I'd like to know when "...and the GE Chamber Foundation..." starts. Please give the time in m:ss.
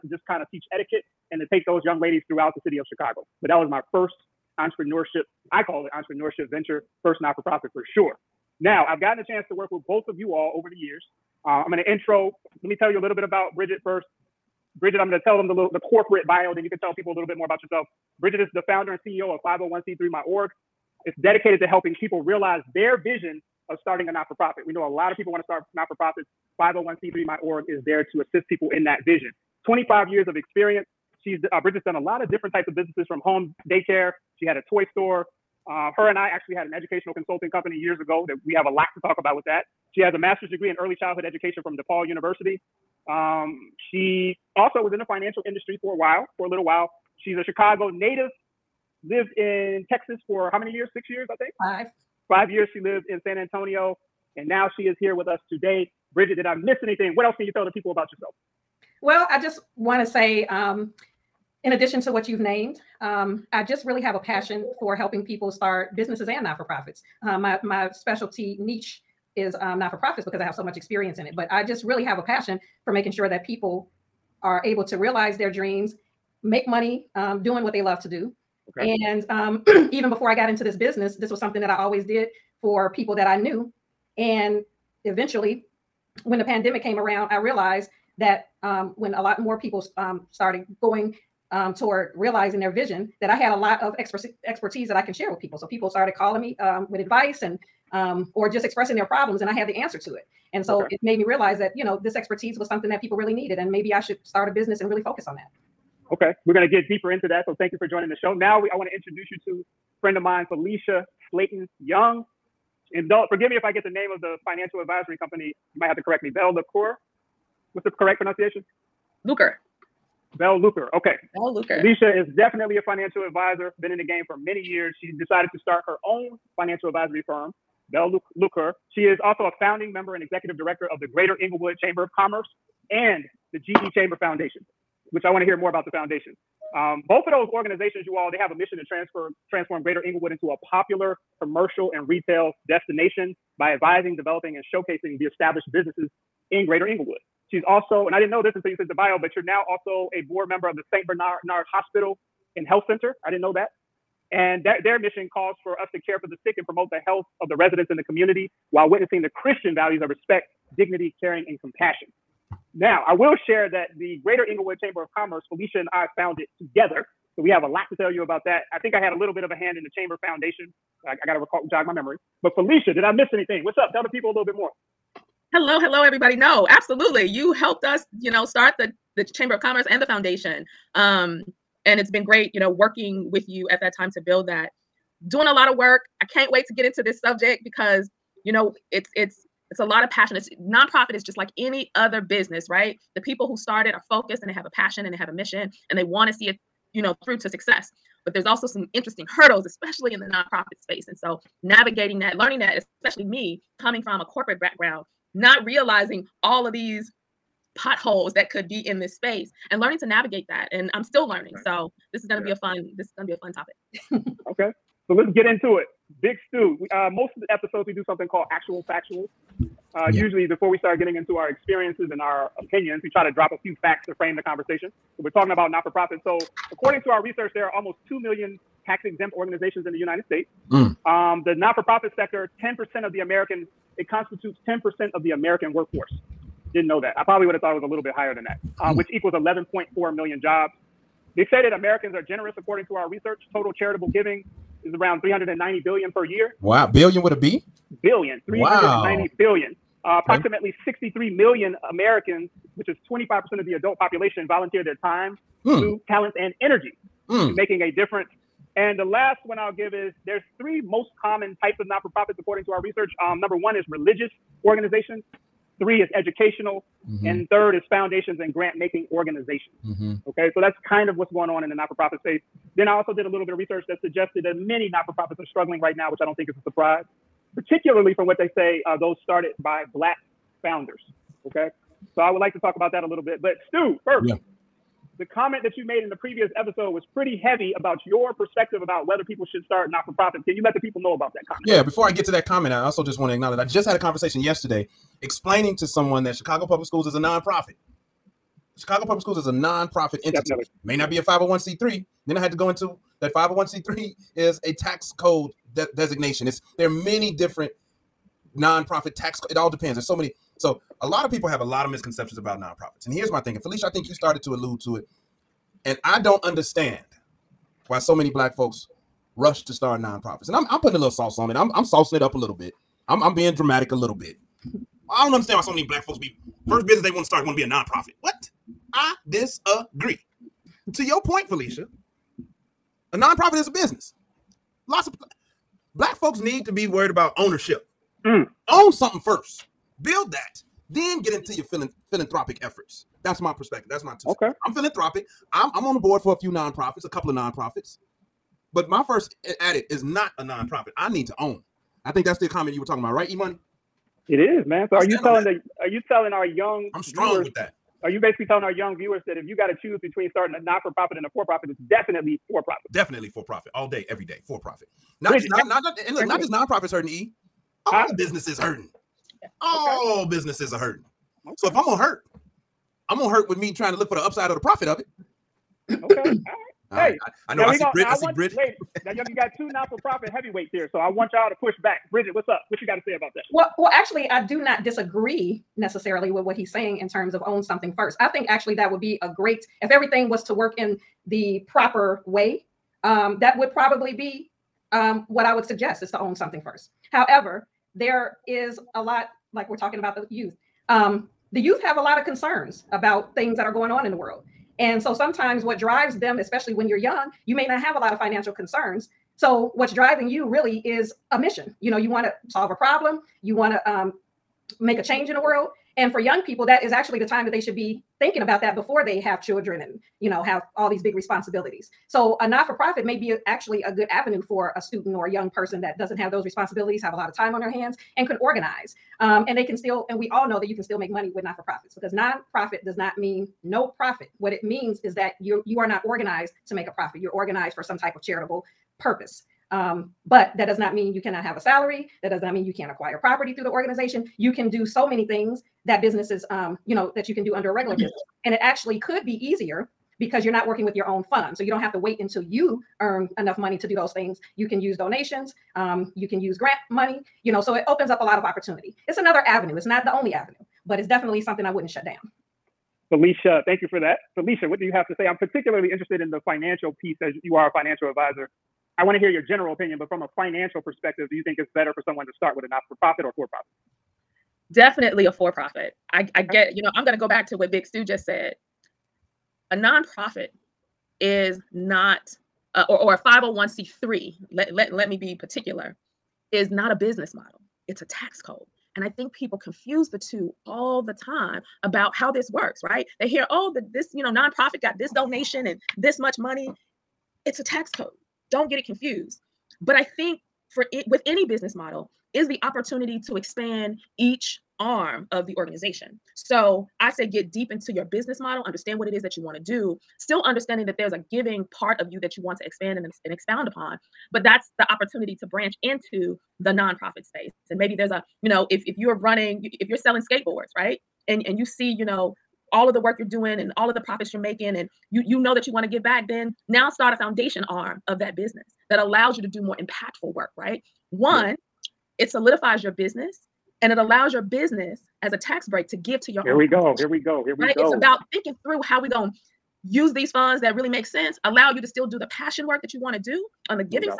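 2:12.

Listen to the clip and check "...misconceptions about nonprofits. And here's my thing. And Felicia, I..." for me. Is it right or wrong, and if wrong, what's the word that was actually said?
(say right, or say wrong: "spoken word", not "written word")
right.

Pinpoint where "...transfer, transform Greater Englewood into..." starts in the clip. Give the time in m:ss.
2:18.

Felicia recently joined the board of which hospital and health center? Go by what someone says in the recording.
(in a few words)
St. Bernard Hospital.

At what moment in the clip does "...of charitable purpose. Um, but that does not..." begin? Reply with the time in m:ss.
7:18.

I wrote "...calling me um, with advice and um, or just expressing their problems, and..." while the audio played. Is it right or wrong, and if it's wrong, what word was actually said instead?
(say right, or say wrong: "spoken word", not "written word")
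right.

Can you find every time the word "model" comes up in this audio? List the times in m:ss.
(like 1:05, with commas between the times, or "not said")
8:07, 8:21, 8:28.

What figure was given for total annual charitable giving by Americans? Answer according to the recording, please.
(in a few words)
390 billion.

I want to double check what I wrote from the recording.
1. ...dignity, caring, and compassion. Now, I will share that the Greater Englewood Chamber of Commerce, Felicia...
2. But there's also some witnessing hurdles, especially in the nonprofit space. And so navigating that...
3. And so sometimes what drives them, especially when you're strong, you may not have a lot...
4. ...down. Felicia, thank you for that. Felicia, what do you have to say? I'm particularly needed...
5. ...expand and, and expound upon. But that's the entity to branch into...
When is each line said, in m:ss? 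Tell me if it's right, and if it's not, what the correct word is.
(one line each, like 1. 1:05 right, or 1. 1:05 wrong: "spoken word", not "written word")
1. 2:40 right
2. 3:18 wrong: "interesting", not "witnessing"
3. 6:44 wrong: "young", not "strong"
4. 7:42 wrong: "interested", not "needed"
5. 8:32 wrong: "opportunity", not "entity".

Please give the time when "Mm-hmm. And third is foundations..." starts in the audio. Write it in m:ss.
4:27.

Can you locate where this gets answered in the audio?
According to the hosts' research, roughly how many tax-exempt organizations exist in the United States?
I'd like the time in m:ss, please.
3:47.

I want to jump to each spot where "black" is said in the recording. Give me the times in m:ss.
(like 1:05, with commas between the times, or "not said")
4:39, 5:18, 5:25, 5:35.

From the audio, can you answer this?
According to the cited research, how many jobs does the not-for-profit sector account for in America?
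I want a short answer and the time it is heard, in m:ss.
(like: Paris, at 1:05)
11.4 million, at 3:59.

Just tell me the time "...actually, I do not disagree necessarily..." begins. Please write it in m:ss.
6:23.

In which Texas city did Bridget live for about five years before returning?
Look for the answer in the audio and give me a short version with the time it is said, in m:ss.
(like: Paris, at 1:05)
San Antonio, at 0:53.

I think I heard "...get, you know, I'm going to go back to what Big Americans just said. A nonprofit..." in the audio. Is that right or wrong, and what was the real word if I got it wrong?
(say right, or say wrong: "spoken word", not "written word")
wrong: "Stu", not "Americans".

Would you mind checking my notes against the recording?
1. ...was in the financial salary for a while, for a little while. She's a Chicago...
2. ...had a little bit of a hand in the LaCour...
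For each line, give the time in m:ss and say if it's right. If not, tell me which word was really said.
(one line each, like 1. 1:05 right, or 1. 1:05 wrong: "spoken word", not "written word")
1. 0:44 wrong: "industry", not "salary"
2. 2:49 wrong: "Chamber", not "LaCour".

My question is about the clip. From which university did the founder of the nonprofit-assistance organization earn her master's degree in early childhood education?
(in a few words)
DePaul University.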